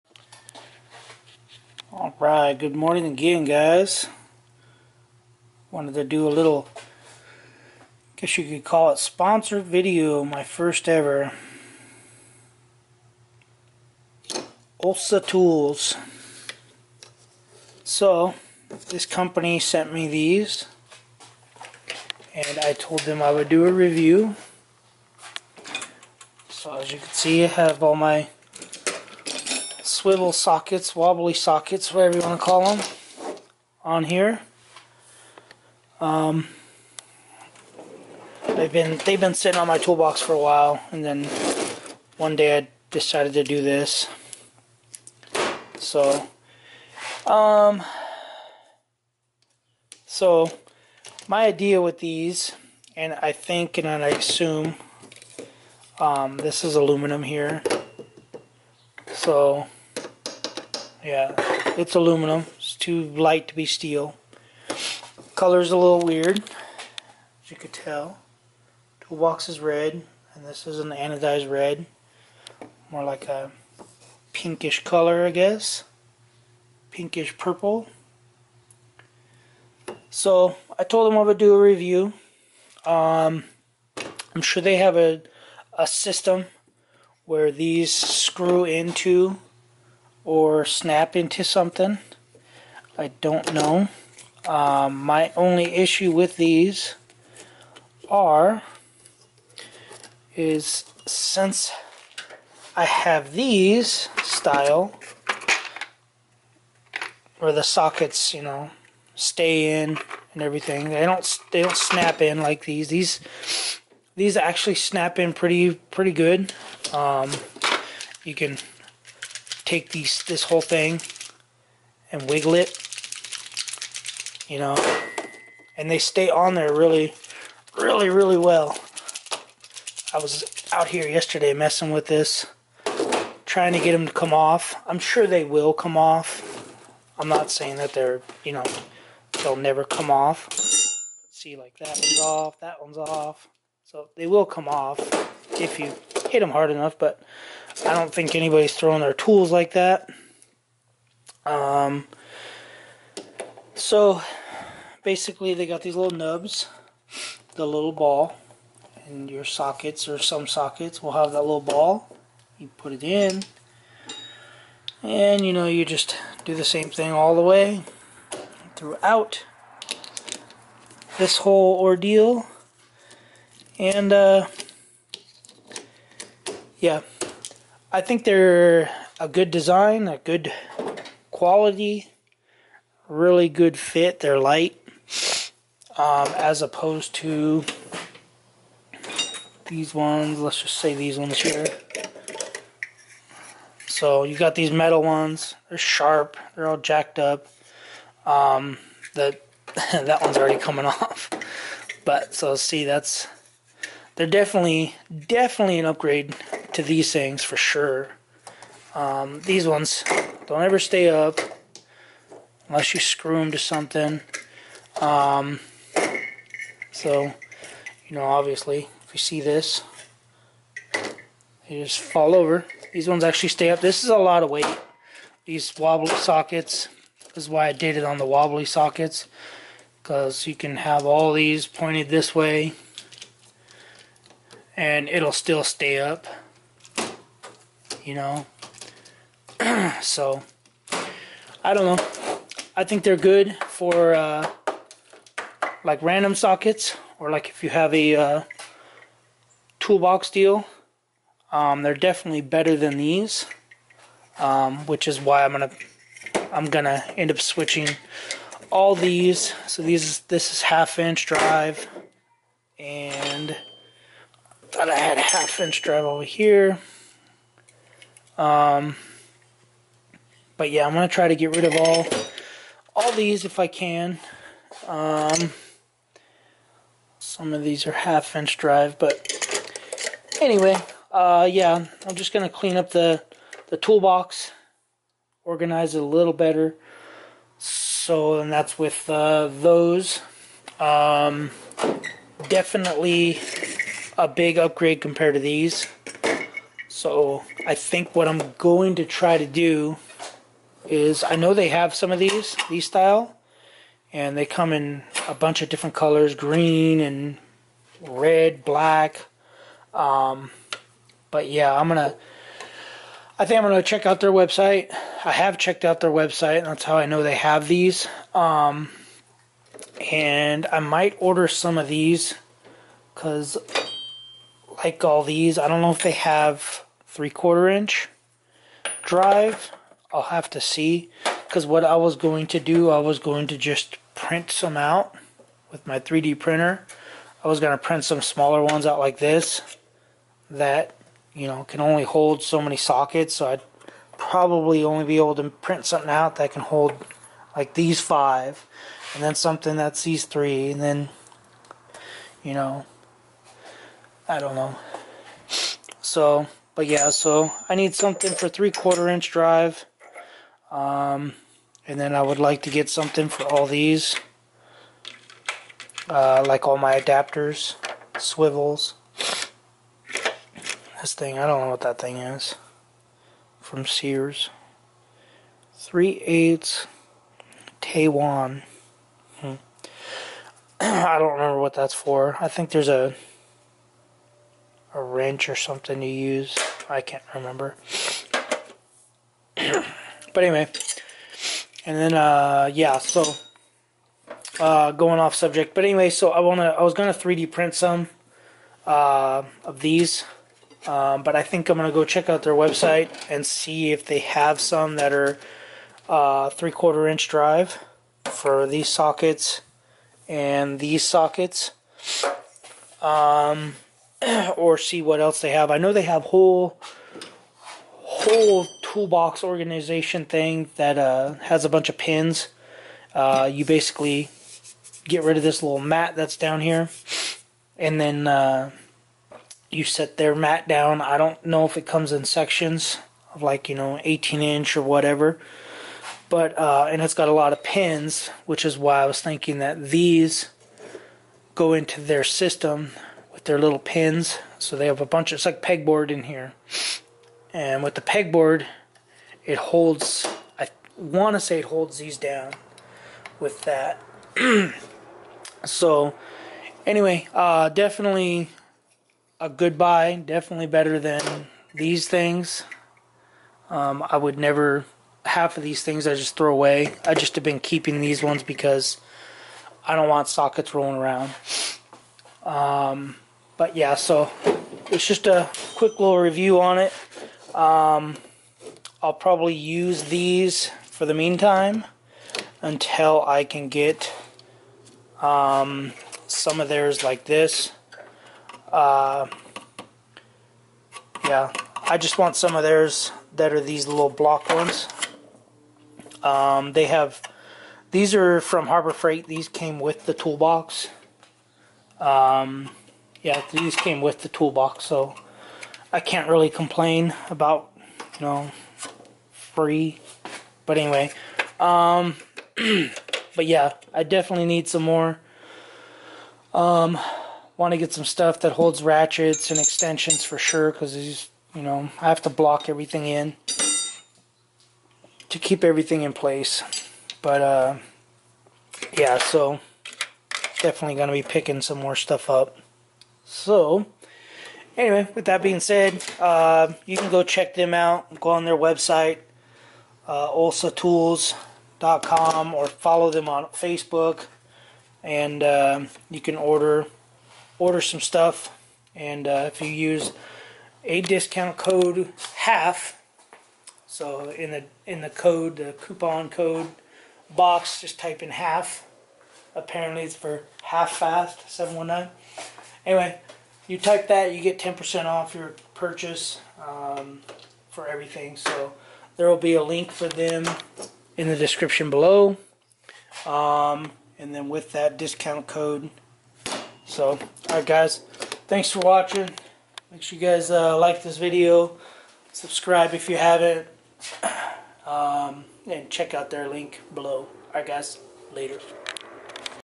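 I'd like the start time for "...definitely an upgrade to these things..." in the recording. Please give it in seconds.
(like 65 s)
205 s.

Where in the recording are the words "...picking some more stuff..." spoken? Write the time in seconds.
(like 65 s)
531 s.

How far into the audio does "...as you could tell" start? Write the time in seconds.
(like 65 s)
67 s.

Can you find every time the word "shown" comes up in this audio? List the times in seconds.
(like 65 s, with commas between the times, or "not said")
not said.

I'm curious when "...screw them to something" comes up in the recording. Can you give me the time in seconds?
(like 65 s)
212 s.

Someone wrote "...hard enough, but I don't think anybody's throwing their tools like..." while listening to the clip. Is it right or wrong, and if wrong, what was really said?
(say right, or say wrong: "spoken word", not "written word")
right.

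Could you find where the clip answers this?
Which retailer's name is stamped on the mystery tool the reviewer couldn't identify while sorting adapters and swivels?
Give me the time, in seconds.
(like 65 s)
373 s.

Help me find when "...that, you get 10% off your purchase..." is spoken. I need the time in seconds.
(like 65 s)
564 s.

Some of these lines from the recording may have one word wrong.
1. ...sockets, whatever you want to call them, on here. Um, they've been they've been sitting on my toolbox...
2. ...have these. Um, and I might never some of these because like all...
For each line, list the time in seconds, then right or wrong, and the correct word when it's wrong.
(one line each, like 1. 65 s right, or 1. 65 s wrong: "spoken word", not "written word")
1. 31 s right
2. 317 s wrong: "order", not "never".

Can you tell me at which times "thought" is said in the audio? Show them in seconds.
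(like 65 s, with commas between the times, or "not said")
264 s.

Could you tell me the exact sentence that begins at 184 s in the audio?
They're light, um, as opposed to these ones.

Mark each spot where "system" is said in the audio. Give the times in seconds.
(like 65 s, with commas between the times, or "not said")
85 s, 442 s.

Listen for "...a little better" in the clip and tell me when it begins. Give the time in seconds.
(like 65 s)
286 s.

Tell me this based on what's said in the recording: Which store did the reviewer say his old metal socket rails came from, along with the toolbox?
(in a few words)
Harbor Freight.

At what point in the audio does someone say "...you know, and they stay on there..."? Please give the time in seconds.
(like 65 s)
124 s.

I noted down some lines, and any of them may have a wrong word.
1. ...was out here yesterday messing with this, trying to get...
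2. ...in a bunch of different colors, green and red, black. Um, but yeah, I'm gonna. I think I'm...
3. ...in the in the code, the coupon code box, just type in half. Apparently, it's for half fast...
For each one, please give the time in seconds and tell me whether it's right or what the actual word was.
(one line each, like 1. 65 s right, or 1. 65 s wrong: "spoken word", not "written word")
1. 130 s right
2. 304 s right
3. 554 s right.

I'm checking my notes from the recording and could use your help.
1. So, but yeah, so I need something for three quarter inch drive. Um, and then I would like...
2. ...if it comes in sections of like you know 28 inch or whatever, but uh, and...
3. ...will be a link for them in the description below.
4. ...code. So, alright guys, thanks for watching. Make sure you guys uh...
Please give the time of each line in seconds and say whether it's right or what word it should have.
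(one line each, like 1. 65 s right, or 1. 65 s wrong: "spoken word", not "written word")
1. 356 s right
2. 431 s wrong: "18", not "28"
3. 569 s right
4. 575 s right.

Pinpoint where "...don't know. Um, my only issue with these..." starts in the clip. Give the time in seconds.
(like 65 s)
93 s.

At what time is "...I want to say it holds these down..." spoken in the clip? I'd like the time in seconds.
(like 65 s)
450 s.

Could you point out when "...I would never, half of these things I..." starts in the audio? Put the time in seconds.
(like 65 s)
464 s.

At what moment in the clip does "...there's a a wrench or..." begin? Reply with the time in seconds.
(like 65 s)
382 s.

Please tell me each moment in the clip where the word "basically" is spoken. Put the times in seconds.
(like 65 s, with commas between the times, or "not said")
155 s, 423 s.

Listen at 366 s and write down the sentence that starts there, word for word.
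Uh, like all my adapters, swivels.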